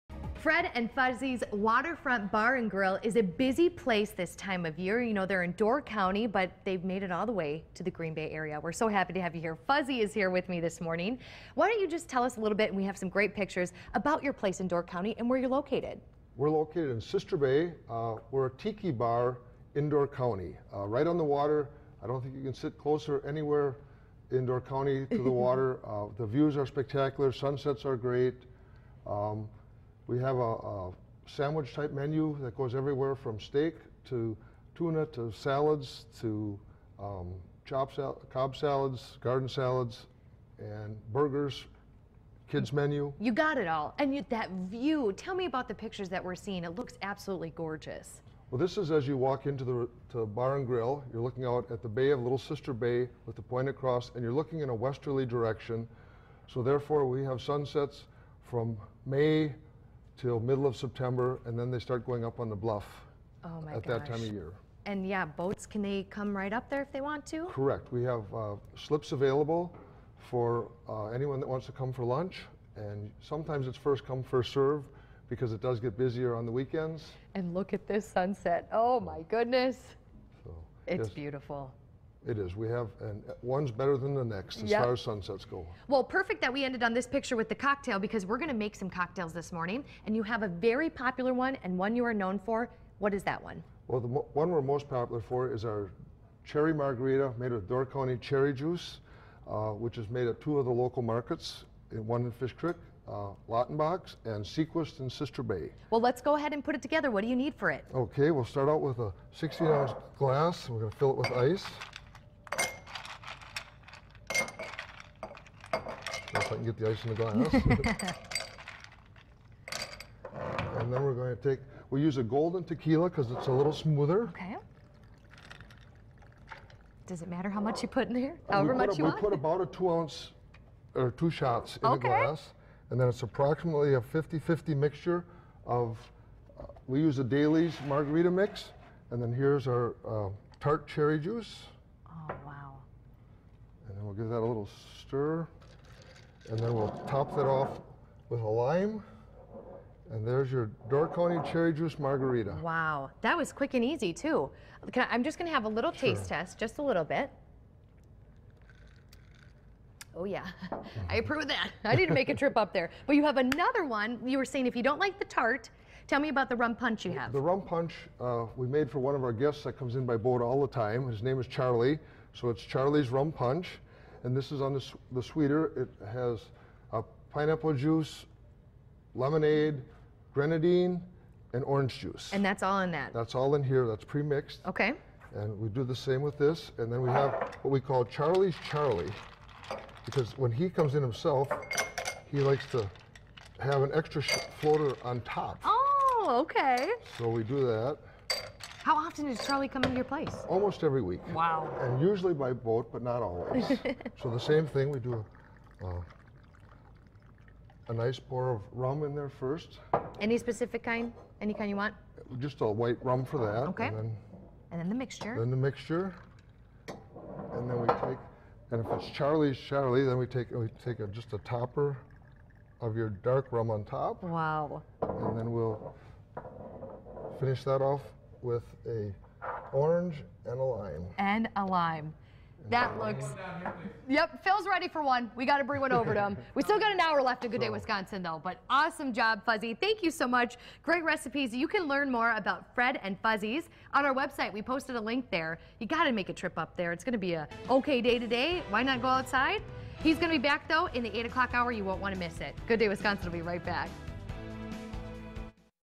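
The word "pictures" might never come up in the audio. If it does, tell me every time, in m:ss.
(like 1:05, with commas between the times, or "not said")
0:13, 0:45, 1:27.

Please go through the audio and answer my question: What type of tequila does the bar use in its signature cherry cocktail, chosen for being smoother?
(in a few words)
golden tequila.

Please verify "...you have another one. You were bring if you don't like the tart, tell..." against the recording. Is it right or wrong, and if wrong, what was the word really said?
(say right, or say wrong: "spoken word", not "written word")
wrong: "saying", not "bring".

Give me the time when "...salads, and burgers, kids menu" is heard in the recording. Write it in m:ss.
0:39.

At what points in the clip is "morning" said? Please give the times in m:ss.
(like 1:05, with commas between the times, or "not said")
0:10, 1:29.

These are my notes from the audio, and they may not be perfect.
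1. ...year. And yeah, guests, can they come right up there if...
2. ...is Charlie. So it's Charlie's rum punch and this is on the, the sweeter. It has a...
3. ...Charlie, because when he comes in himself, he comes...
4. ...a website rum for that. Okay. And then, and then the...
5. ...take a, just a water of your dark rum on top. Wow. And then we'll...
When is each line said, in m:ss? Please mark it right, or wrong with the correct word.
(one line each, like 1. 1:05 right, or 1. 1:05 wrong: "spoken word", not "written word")
1. 1:04 wrong: "boats", not "guests"
2. 2:51 right
3. 3:08 wrong: "likes", not "comes"
4. 3:32 wrong: "white", not "website"
5. 3:40 wrong: "topper", not "water".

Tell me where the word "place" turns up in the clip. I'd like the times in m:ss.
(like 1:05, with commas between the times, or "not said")
0:03, 0:14, 3:20.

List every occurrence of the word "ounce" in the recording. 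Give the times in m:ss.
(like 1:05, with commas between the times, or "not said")
1:49, 2:09.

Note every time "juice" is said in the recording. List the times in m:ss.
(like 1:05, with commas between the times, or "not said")
1:38, 2:21, 2:31, 2:57, 3:01.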